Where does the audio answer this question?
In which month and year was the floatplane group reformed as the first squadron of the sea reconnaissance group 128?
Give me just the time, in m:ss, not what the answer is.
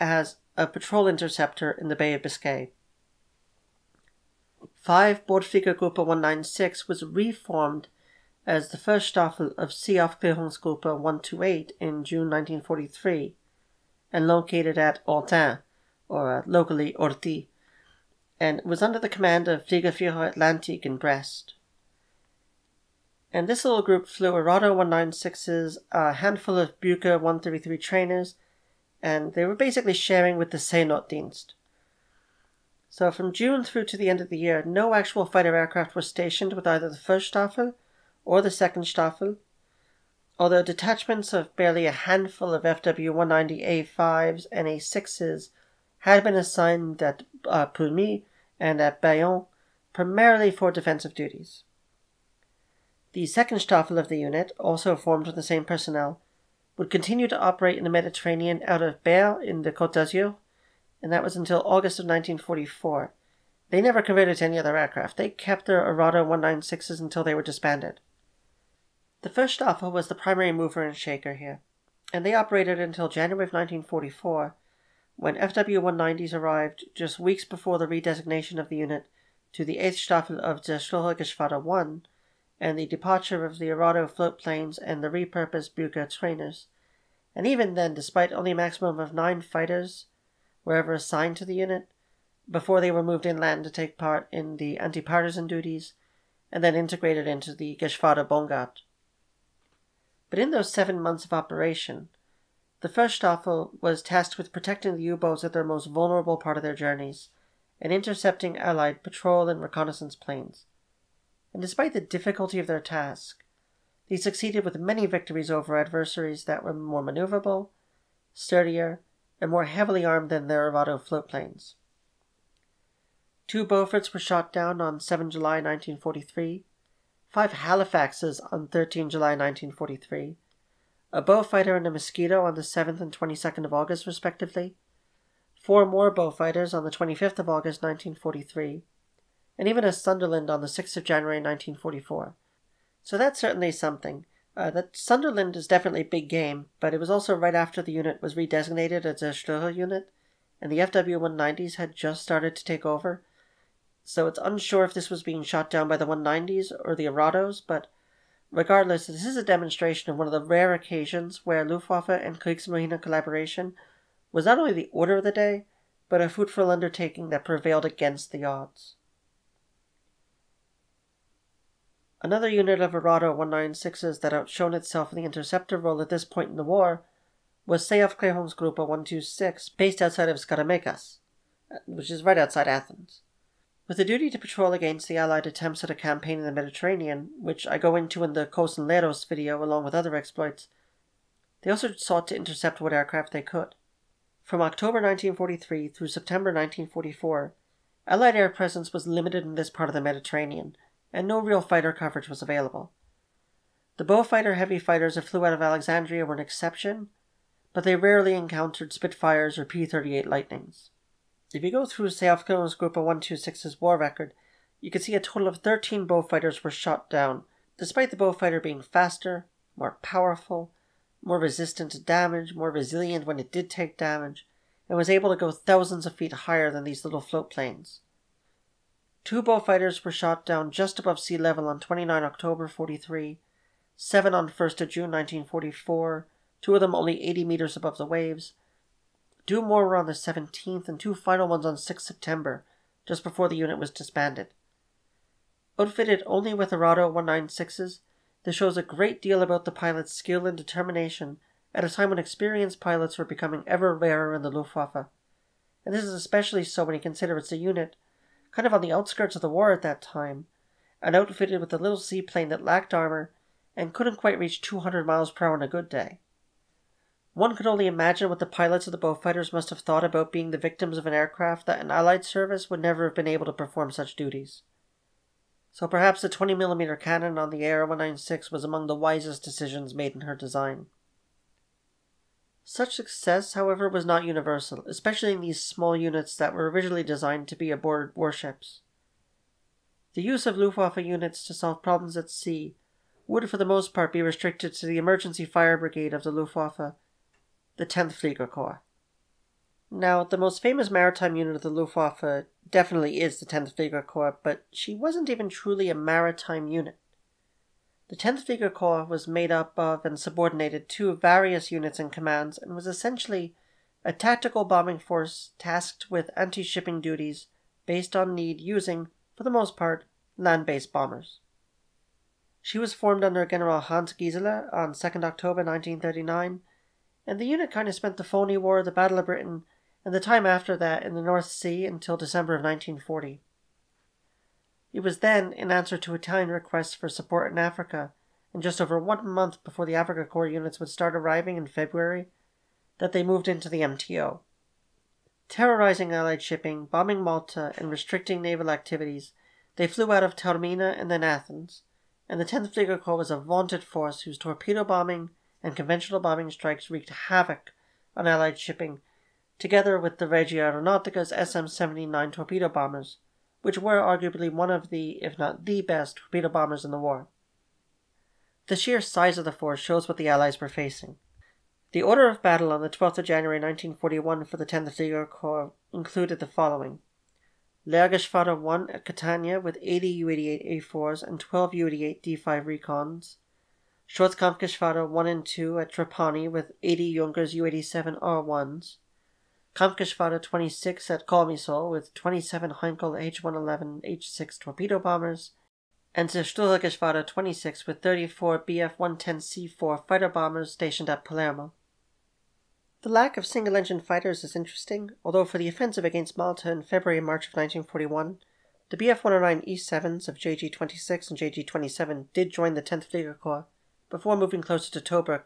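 0:12.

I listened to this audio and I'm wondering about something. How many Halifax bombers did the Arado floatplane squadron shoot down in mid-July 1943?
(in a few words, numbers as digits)
5.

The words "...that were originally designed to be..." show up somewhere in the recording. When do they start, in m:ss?
4:46.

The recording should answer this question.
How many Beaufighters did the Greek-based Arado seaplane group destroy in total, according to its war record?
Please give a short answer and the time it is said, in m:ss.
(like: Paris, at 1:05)
13, at 3:35.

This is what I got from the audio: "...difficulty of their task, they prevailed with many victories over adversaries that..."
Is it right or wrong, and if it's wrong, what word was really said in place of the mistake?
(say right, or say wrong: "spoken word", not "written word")
wrong: "succeeded", not "prevailed".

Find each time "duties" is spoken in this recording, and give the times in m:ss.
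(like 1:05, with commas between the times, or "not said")
0:51, 1:35, 4:34, 5:16.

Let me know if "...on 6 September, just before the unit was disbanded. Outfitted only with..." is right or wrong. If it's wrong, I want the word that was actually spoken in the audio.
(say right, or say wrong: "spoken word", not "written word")
right.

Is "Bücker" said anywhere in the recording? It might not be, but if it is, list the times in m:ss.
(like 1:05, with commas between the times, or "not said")
0:26, 1:25.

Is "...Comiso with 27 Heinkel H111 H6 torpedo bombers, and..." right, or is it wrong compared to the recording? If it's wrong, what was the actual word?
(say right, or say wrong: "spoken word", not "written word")
right.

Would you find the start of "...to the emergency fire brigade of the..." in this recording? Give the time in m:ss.
4:54.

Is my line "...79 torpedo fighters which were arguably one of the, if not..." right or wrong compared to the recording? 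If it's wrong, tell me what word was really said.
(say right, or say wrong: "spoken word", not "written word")
wrong: "bombers", not "fighters".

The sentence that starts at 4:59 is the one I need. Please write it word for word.
Now, the most famous maritime unit of the Luftwaffe definitely is the 10th Fliegerkorps, but she wasn't even truly a maritime unit.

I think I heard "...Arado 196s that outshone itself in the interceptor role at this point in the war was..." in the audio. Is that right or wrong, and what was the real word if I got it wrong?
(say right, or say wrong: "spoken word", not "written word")
right.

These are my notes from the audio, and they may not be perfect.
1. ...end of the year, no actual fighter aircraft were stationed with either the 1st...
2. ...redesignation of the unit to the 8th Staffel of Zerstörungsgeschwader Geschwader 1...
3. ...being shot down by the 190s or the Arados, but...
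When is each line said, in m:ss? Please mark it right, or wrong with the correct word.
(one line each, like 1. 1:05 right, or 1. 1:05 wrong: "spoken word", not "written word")
1. 0:34 right
2. 1:17 right
3. 2:35 right.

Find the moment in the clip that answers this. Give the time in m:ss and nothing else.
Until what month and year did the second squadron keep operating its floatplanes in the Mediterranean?
1:01.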